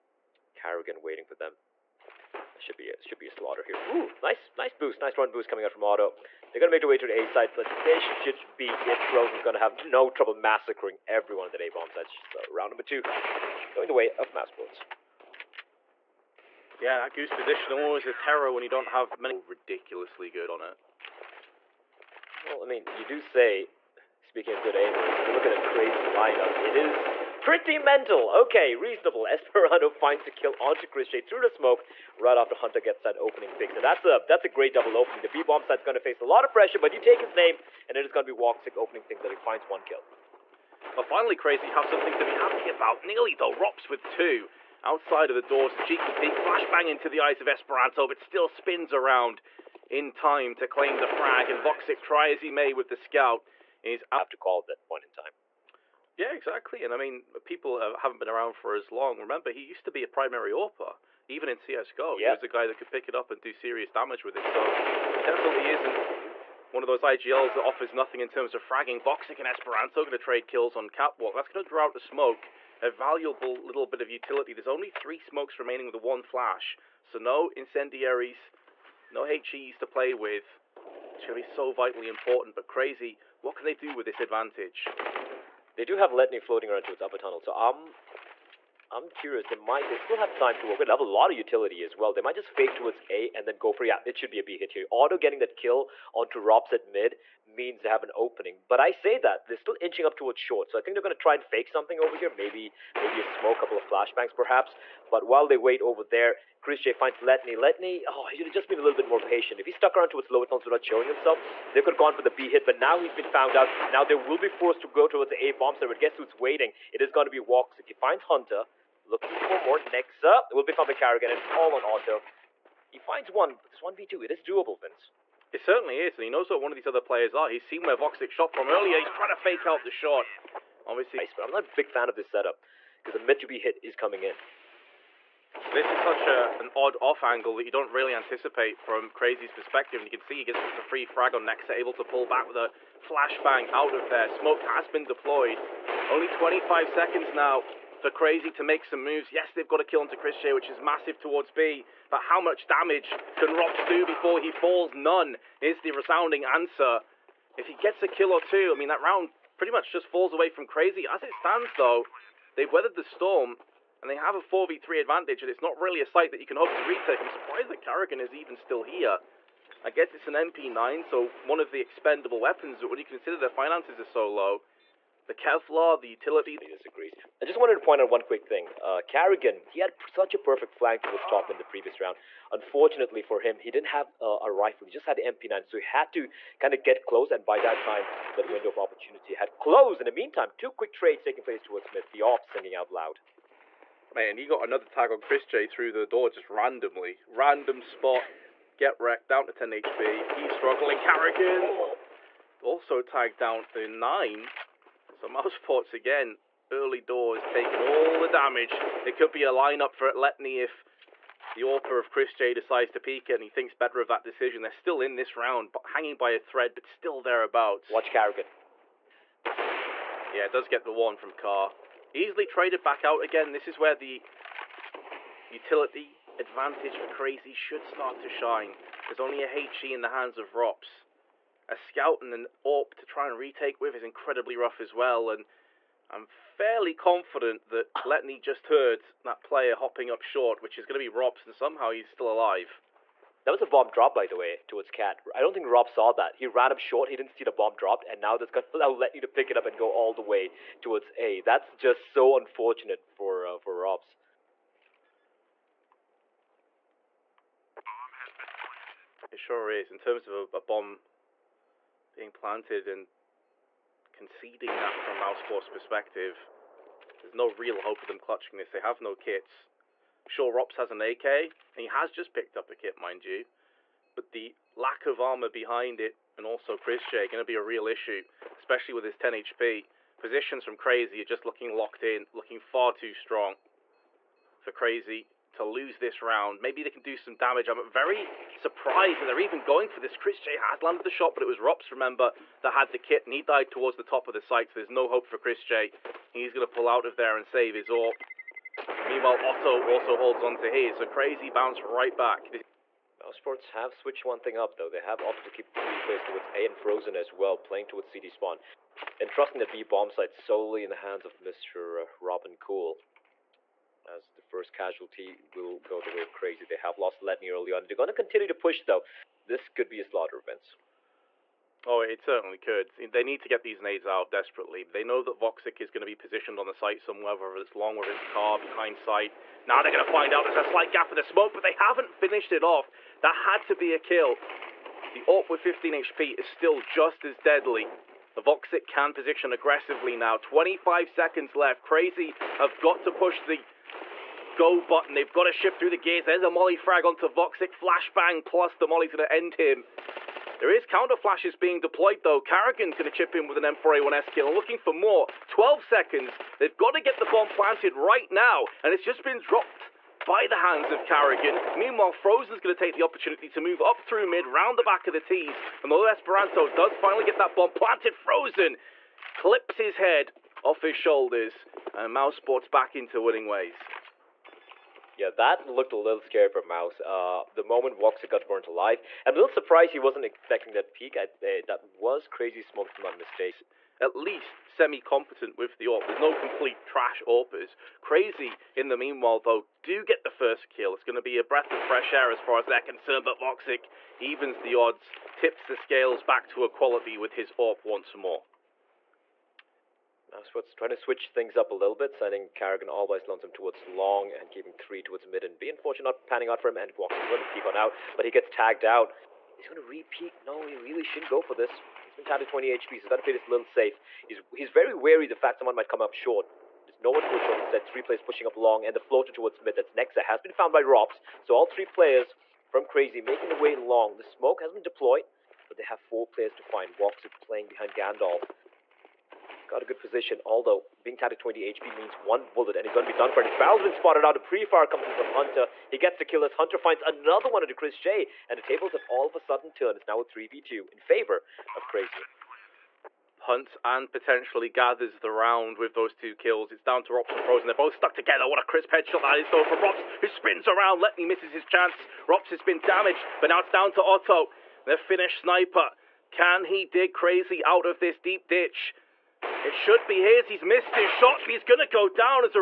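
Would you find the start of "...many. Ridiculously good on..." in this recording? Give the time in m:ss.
0:19.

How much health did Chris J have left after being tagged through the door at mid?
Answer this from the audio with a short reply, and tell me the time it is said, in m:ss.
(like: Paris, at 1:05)
10 HP, at 3:19.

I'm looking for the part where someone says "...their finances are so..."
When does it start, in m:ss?
2:53.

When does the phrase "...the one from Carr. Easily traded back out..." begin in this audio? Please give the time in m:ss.
3:40.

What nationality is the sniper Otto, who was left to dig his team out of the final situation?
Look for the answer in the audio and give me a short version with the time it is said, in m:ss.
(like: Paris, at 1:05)
Finnish, at 7:34.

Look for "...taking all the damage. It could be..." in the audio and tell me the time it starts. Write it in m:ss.
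3:27.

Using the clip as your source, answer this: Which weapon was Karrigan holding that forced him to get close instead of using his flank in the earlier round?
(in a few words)
MP9.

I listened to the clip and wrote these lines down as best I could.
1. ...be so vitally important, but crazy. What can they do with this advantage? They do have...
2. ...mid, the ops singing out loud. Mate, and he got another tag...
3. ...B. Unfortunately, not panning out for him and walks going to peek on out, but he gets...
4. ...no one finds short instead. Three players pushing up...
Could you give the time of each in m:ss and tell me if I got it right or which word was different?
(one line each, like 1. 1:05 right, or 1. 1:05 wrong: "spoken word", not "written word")
1. 1:21 right
2. 3:11 right
3. 6:45 right
4. 6:57 wrong: "towards", not "finds".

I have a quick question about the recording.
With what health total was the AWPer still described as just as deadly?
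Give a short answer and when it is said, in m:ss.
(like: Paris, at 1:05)
15 HP, at 5:35.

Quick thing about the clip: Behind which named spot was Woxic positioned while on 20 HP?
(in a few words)
Gandalf.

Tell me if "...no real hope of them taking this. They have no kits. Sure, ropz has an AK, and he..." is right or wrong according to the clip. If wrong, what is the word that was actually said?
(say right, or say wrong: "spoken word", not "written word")
wrong: "clutching", not "taking".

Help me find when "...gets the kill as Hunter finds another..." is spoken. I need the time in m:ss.
7:15.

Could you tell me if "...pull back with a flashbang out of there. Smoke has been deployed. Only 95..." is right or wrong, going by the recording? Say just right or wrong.
wrong.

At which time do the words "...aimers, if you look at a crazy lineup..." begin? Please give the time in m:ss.
0:24.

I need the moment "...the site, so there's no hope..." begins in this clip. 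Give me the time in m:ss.
4:54.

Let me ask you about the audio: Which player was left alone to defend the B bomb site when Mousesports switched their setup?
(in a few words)
Robin Cool.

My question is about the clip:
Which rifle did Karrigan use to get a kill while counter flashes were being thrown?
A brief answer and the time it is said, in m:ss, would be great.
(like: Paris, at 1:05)
M4A1S, at 5:53.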